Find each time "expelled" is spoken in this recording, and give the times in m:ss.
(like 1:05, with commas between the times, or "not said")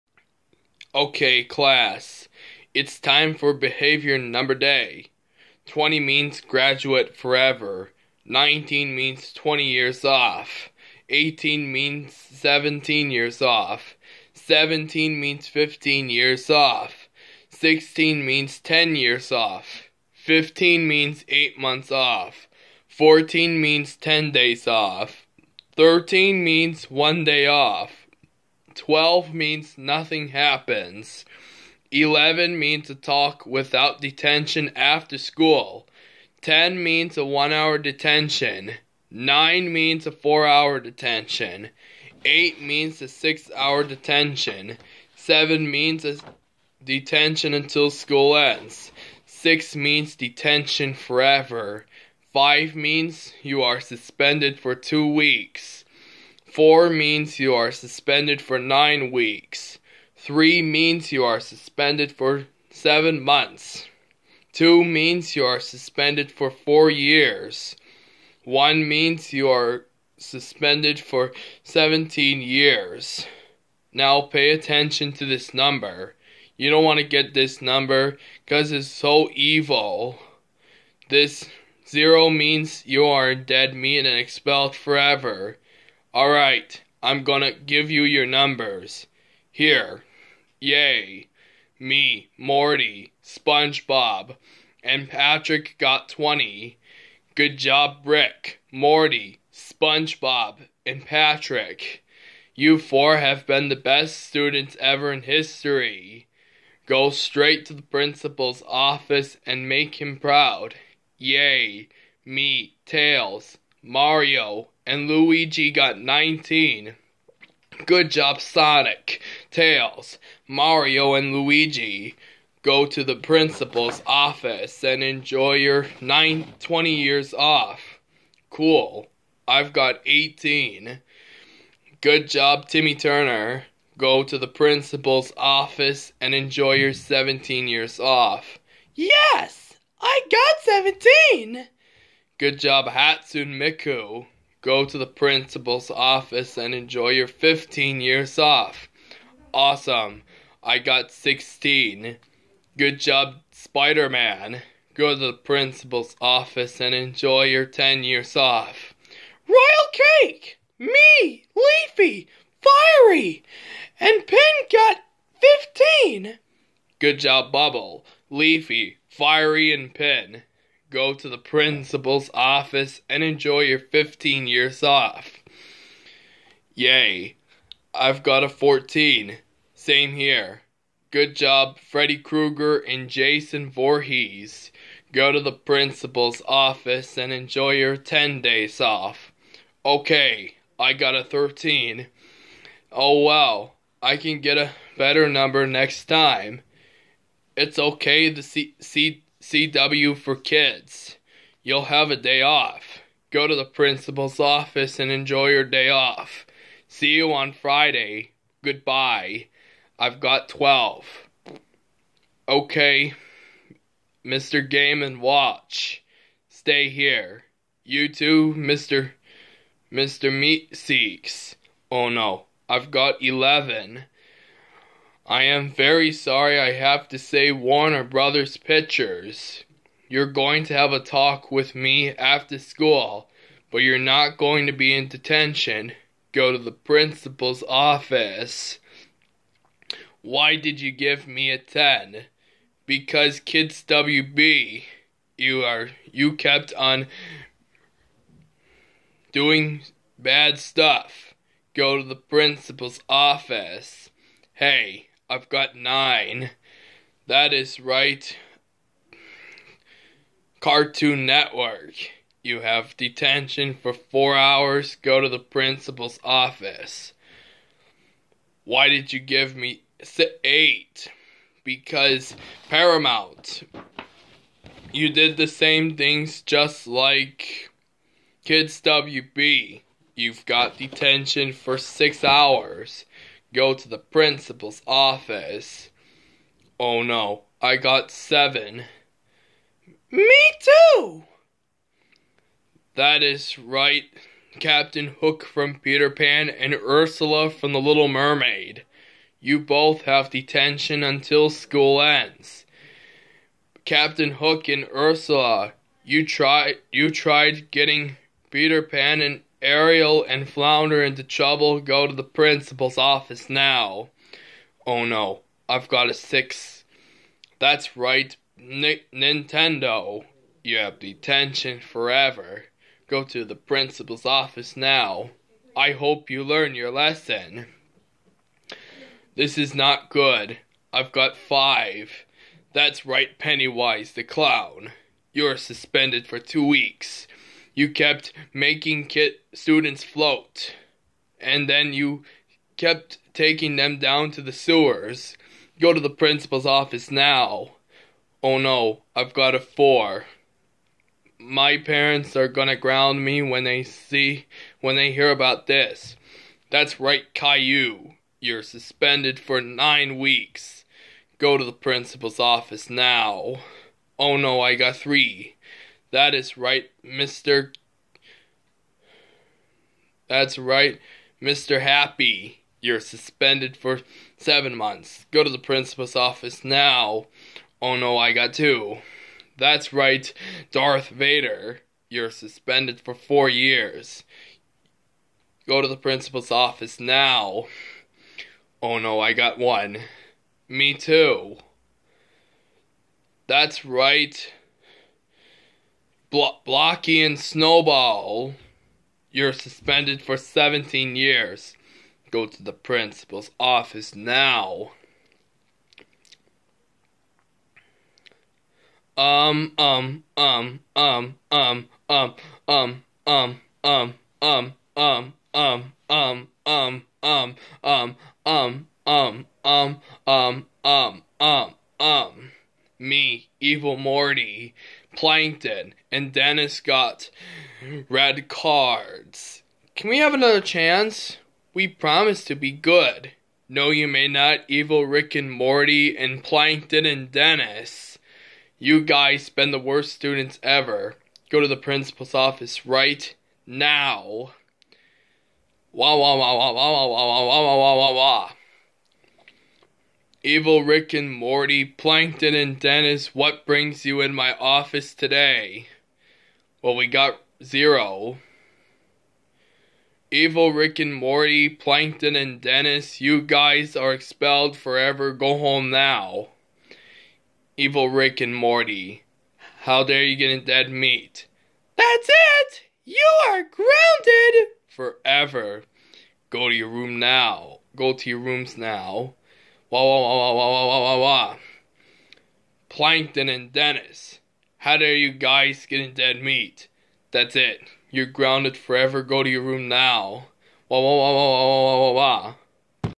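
1:24, 7:44.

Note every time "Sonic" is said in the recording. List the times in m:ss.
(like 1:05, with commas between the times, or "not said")
1:58.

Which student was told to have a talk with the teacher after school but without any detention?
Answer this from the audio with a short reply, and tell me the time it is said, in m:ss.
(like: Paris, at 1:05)
Warner Brothers Pictures, at 3:47.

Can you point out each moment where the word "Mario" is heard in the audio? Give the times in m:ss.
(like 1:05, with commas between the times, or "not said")
1:53, 2:00.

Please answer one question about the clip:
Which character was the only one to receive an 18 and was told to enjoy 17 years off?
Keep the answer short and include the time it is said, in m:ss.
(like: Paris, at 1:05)
Timmy Turner, at 2:12.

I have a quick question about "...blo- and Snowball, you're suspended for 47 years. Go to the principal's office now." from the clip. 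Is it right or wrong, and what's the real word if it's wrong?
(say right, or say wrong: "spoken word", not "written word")
wrong: "17", not "47".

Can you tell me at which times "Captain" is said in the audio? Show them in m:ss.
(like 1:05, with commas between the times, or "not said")
4:54, 5:03.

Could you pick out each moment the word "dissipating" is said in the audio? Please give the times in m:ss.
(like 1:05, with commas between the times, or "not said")
not said.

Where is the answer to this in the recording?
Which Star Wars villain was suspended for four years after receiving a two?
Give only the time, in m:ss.
6:20.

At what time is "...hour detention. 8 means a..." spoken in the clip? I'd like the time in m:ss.
0:40.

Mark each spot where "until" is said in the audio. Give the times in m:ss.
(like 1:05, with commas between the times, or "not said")
0:47, 5:01.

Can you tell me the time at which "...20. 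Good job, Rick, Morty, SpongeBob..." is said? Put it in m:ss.
1:36.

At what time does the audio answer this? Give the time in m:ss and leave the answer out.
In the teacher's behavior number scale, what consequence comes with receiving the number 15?
0:21.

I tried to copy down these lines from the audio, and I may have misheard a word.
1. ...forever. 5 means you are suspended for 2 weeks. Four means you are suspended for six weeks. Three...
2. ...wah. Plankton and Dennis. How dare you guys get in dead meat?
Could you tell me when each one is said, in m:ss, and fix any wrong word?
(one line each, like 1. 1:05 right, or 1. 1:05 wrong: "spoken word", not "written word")
1. 0:50 wrong: "nine", not "six"
2. 8:01 right.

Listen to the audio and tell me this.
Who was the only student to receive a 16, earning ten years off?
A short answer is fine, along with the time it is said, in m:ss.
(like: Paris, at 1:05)
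Spider Man, at 2:33.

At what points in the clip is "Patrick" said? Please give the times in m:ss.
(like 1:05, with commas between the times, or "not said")
1:35, 1:41.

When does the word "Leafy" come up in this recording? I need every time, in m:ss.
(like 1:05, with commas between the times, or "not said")
2:41, 2:48.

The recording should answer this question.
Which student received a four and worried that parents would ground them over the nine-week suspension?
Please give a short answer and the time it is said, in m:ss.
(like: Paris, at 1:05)
Caillou, at 5:57.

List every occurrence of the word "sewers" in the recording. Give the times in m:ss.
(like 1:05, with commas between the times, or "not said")
5:44.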